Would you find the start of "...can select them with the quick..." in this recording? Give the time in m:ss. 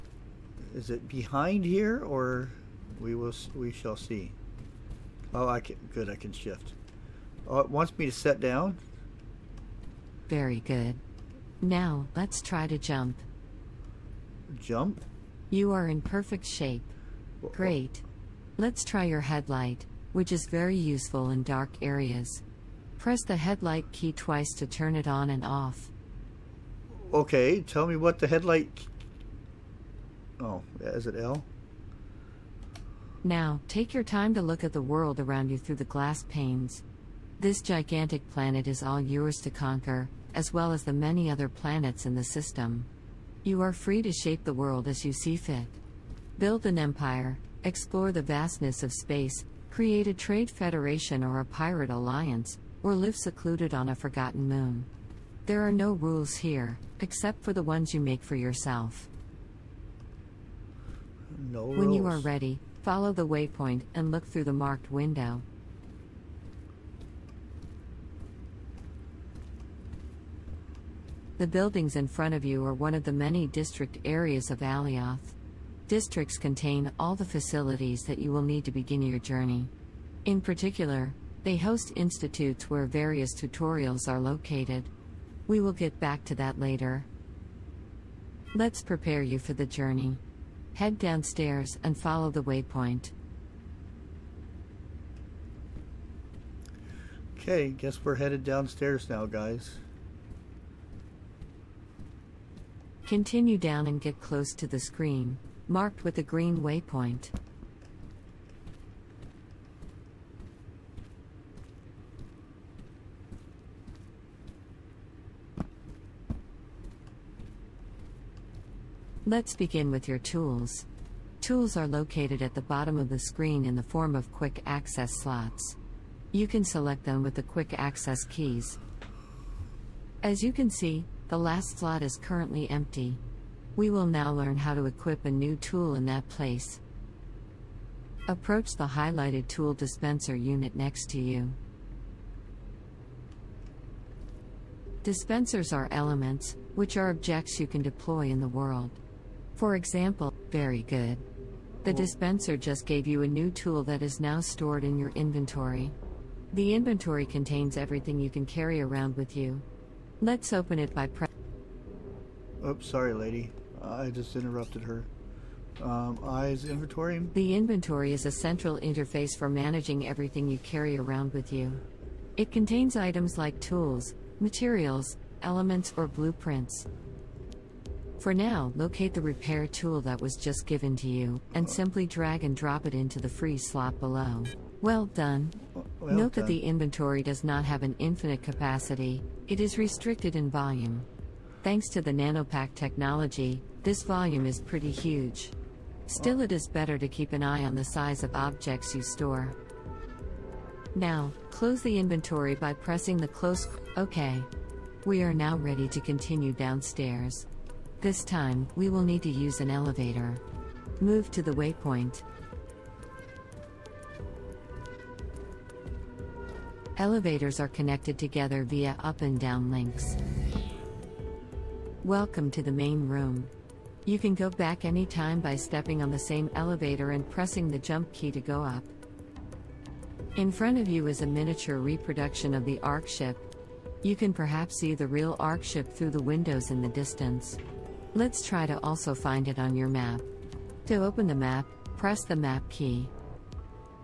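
2:06.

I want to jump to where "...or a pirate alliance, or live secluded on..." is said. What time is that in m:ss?
0:51.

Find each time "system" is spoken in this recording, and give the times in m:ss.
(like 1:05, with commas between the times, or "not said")
0:42.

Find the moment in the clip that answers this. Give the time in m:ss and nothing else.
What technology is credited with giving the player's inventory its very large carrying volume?
3:12.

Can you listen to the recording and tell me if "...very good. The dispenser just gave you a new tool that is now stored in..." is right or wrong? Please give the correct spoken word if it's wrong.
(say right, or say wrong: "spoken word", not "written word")
right.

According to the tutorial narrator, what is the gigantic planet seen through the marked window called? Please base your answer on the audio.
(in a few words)
Alioth.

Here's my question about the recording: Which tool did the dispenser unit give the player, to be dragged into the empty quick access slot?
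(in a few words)
Repair tool.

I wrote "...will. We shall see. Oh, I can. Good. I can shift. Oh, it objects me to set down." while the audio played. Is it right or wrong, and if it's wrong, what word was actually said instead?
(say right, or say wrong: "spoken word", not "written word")
wrong: "wants", not "objects".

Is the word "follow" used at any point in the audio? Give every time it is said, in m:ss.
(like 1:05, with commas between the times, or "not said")
1:02, 1:31.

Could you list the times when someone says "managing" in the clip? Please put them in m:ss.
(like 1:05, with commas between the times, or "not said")
2:49.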